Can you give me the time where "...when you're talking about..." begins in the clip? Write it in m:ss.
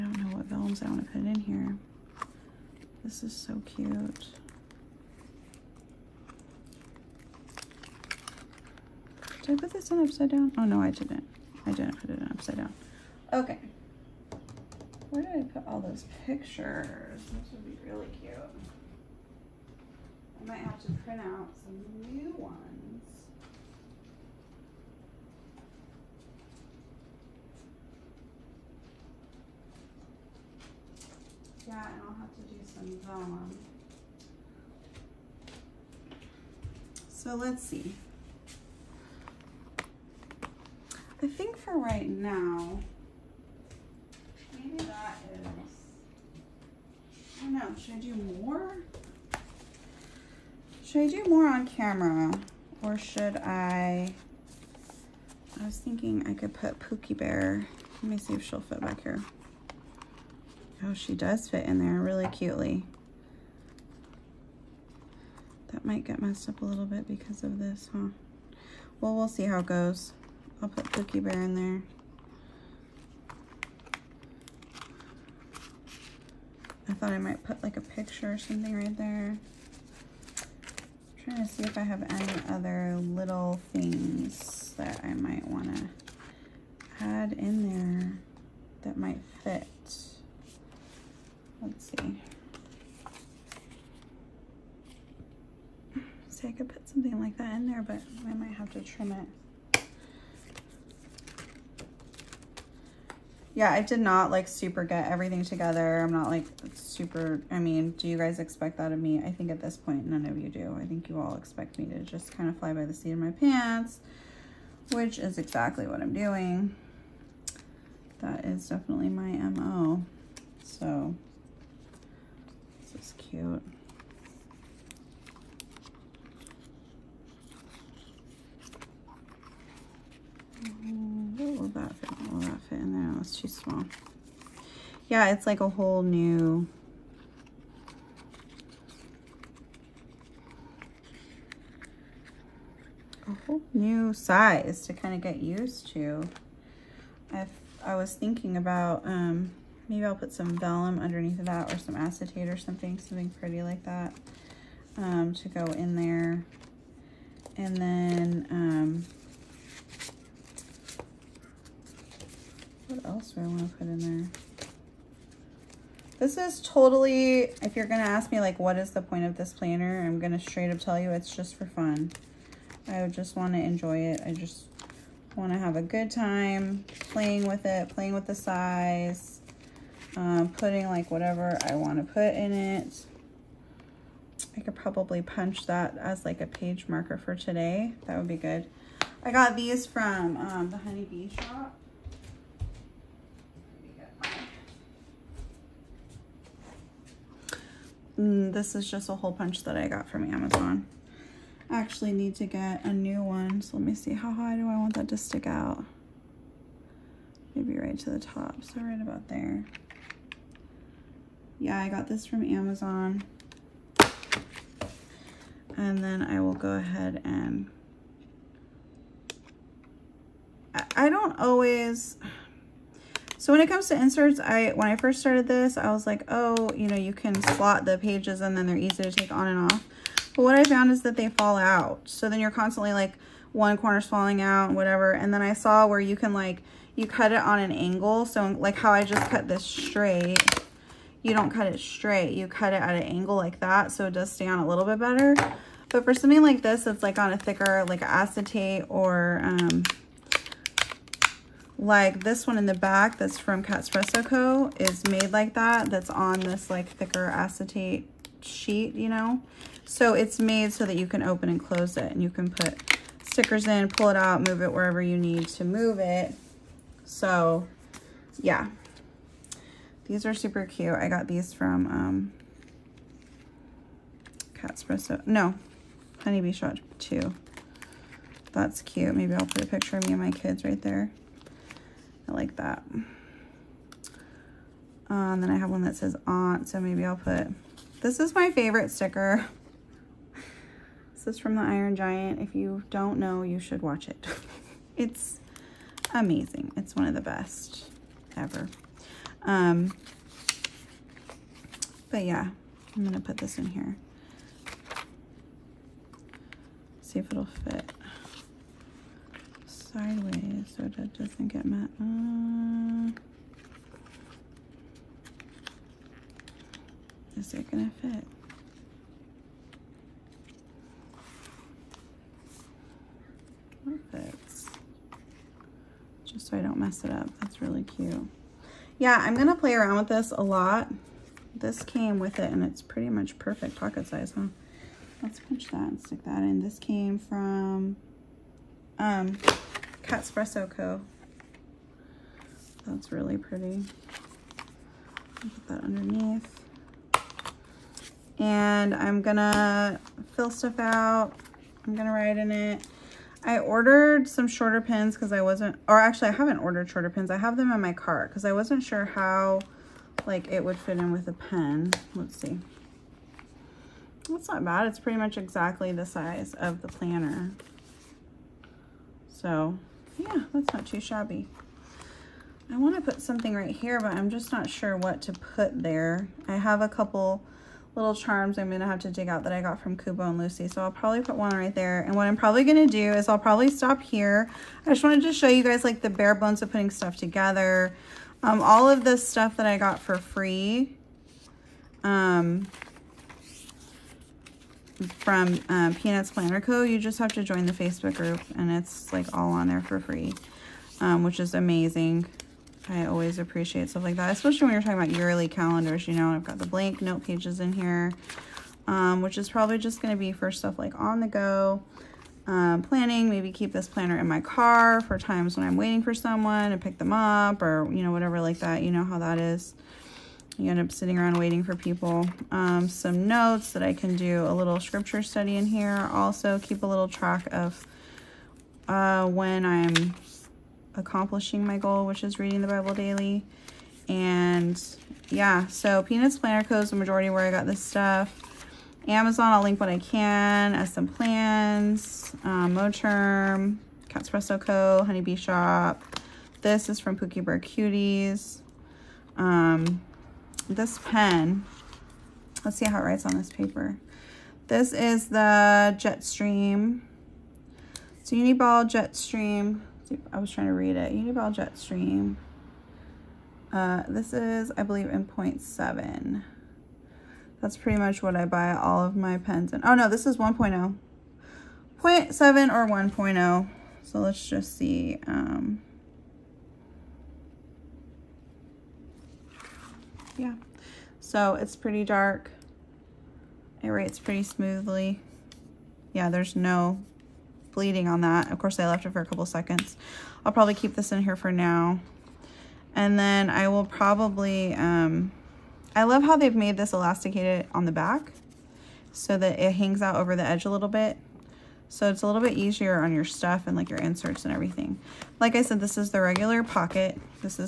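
6:44.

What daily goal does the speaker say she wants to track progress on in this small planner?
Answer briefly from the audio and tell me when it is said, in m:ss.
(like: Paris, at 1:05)
Reading the Bible daily, at 7:12.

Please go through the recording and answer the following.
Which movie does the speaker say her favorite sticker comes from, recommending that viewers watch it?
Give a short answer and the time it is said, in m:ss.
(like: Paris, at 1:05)
The Iron Giant, at 4:51.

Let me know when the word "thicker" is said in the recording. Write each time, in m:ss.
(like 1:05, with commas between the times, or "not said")
4:07, 4:16.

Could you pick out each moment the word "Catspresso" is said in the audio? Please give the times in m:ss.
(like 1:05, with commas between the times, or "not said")
4:13, 5:40, 7:24.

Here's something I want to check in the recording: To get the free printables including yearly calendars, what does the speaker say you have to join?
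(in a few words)
Facebook group.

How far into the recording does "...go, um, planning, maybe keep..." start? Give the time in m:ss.
6:51.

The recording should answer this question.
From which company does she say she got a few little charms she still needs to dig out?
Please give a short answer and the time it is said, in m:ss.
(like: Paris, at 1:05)
Kubo and Lucy, at 6:19.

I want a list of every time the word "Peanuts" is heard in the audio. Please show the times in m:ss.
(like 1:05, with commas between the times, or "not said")
6:35, 7:16.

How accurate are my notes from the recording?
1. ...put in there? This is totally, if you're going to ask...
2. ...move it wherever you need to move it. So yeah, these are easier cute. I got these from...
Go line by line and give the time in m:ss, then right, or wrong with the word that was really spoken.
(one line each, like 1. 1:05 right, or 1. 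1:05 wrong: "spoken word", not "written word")
1. 2:43 right
2. 4:24 wrong: "super", not "easier".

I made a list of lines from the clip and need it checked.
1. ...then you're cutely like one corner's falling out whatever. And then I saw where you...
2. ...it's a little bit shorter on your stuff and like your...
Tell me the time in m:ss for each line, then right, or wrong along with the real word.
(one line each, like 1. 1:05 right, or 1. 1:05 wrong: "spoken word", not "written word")
1. 3:52 wrong: "constantly", not "cutely"
2. 8:22 wrong: "easier", not "shorter".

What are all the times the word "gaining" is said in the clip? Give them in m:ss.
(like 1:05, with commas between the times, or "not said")
not said.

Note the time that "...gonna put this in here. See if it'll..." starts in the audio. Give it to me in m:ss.
5:03.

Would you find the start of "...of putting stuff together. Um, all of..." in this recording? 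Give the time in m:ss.
6:26.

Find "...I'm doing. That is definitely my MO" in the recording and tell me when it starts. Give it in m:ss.
1:55.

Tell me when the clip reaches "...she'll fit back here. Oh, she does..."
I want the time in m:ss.
0:58.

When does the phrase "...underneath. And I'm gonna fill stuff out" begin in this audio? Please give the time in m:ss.
5:45.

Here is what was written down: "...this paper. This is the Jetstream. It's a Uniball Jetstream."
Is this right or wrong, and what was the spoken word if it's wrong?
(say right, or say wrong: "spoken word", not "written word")
right.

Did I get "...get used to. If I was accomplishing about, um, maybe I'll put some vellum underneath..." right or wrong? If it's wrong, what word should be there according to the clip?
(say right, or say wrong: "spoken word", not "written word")
wrong: "thinking", not "accomplishing".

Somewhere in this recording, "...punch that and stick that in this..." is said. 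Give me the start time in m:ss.
5:35.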